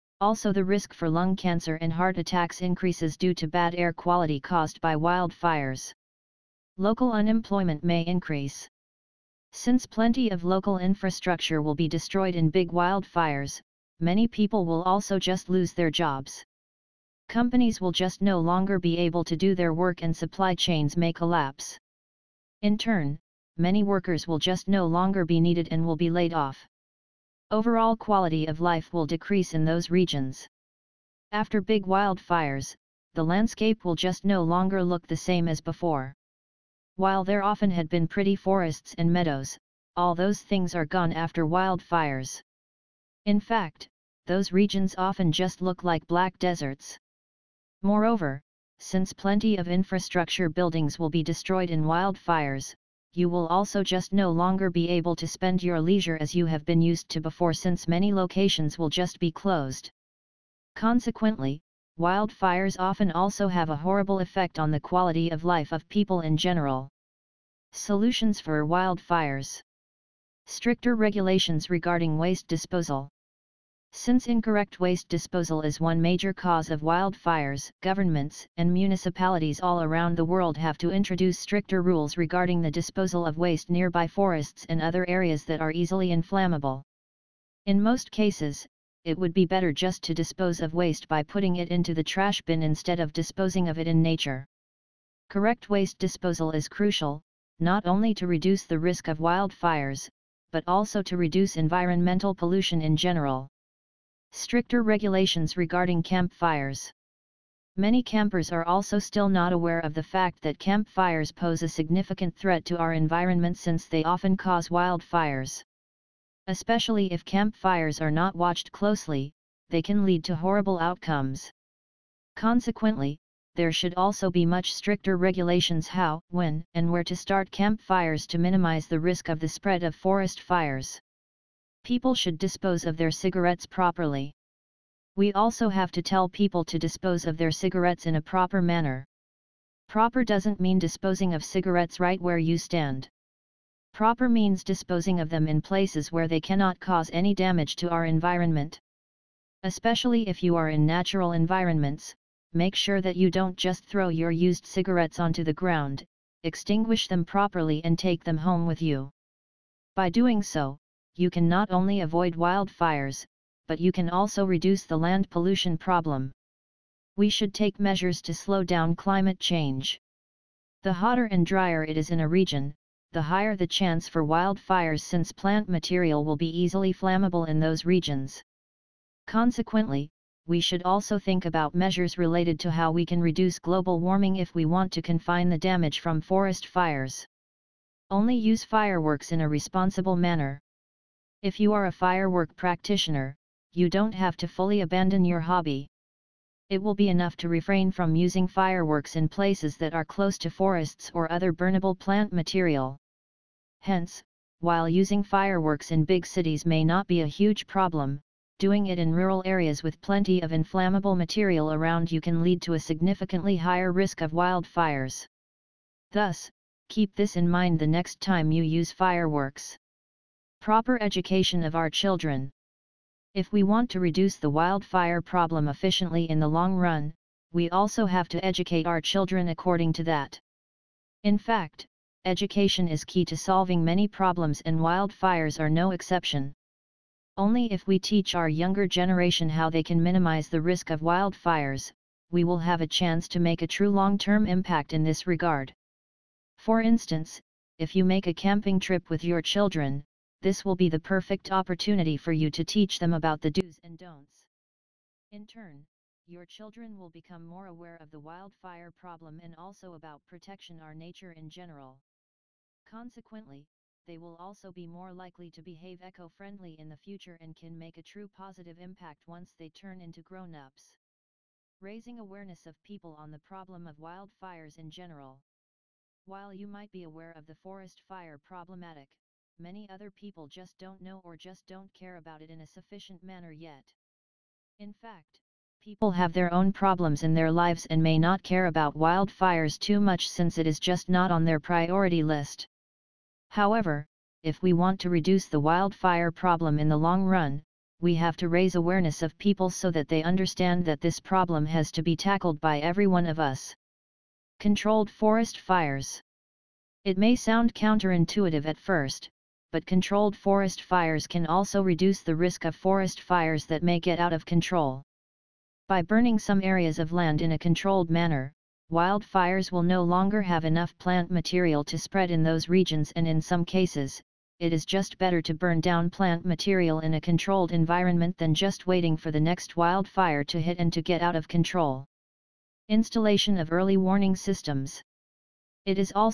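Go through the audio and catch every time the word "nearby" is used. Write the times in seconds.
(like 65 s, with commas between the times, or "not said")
83 s.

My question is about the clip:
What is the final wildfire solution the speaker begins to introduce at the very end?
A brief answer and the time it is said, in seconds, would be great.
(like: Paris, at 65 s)
Early warning systems, at 333 s.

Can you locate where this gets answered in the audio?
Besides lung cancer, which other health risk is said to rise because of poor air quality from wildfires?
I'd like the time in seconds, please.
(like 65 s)
1 s.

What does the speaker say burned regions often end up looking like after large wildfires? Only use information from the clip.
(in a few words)
Black deserts.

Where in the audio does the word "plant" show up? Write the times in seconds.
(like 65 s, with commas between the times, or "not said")
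175 s, 201 s, 320 s, 326 s.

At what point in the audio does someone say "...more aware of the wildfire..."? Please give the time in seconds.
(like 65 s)
257 s.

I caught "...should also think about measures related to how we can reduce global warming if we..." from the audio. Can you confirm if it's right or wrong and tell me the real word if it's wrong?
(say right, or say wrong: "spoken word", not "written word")
right.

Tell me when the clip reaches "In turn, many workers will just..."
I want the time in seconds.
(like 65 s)
22 s.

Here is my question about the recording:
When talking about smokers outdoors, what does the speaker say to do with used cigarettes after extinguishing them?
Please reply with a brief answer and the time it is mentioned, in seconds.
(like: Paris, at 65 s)
Take them home, at 157 s.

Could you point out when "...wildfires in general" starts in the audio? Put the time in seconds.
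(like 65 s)
273 s.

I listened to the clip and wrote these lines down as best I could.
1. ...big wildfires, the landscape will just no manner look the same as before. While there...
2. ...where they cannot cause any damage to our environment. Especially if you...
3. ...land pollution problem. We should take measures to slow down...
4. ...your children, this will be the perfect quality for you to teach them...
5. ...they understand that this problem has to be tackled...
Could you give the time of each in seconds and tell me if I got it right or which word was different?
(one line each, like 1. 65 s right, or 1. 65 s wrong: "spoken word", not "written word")
1. 31 s wrong: "longer", not "manner"
2. 146 s right
3. 164 s right
4. 249 s wrong: "opportunity", not "quality"
5. 300 s right.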